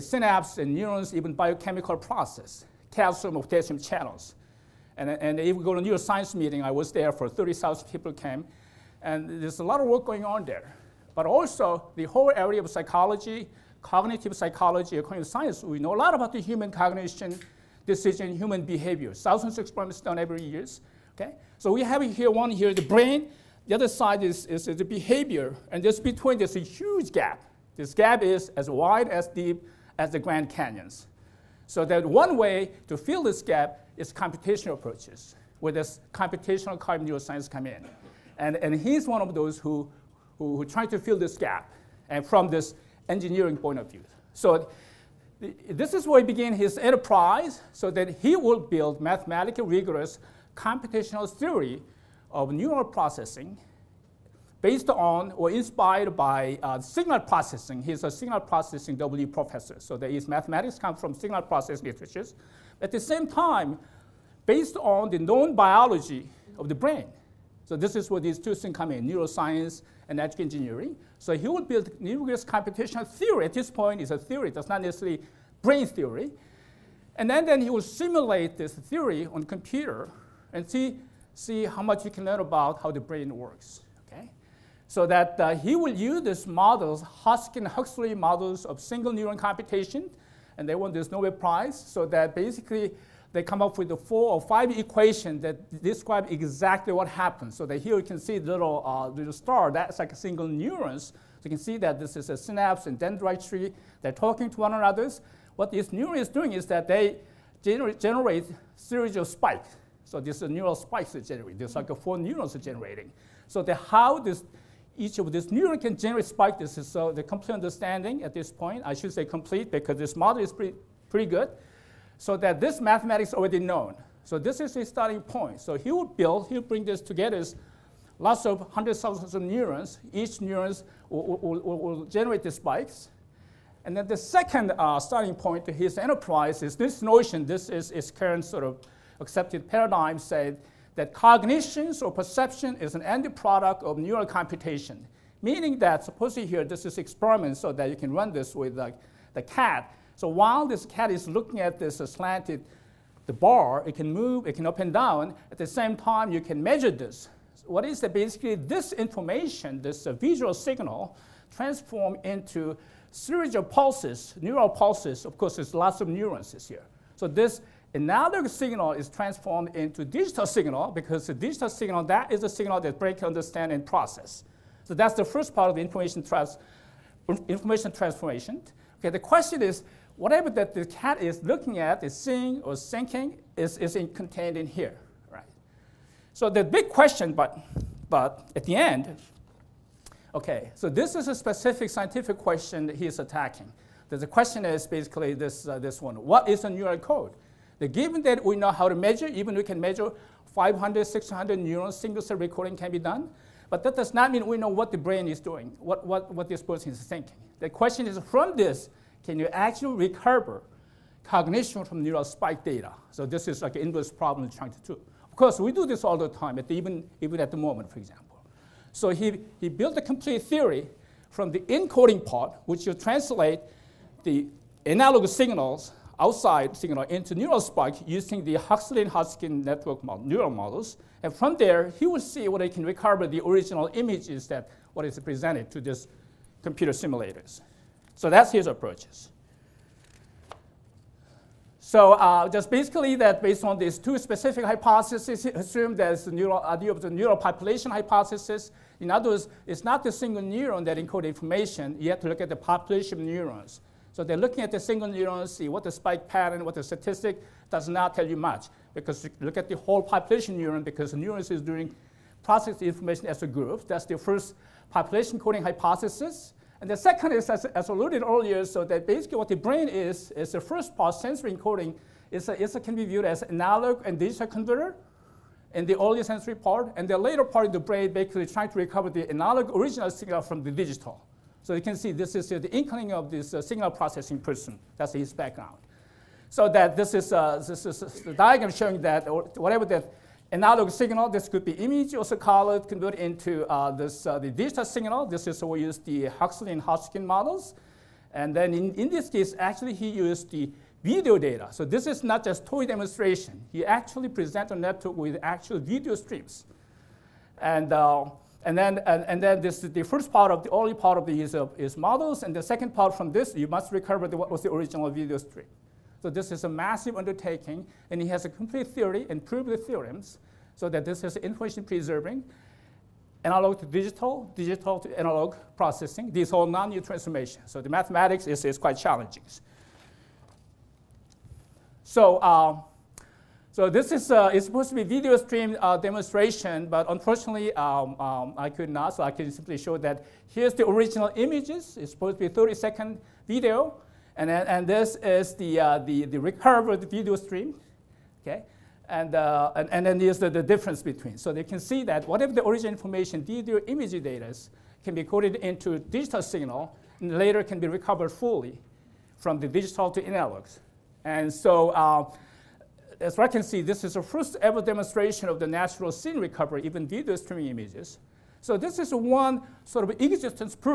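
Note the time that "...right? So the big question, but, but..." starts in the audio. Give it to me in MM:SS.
03:05.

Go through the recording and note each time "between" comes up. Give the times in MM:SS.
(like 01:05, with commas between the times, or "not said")
00:25, 05:51.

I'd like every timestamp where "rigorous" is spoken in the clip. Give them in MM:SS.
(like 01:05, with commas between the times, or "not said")
00:49.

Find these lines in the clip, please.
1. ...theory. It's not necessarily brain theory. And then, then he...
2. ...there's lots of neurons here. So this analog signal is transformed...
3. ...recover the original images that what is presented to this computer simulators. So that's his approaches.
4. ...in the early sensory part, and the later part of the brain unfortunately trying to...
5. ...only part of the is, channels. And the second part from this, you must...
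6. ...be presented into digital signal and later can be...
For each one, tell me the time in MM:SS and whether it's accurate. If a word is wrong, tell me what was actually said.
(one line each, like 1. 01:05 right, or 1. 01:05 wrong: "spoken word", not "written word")
1. 01:14 right
2. 02:45 right
3. 03:52 right
4. 04:35 wrong: "basically", not "unfortunately"
5. 05:10 wrong: "models", not "channels"
6. 05:55 wrong: "coded", not "presented".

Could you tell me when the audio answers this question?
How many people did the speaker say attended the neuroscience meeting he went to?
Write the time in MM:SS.
00:07.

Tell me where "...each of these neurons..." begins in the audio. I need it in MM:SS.
01:54.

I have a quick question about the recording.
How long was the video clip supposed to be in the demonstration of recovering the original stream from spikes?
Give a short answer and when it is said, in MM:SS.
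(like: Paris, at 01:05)
30 seconds, at 05:42.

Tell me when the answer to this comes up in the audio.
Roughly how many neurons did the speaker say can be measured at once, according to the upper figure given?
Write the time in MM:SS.
03:21.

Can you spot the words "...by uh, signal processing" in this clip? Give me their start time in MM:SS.
00:56.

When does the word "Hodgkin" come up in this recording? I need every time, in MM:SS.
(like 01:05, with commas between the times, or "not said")
01:27, 04:56.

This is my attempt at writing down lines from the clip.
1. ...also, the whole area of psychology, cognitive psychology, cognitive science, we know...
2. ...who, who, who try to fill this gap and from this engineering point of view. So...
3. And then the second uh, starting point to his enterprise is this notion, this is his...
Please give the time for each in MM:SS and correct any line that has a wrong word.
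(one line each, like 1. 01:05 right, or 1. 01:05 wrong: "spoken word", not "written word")
1. 00:11 right
2. 00:39 right
3. 02:13 right.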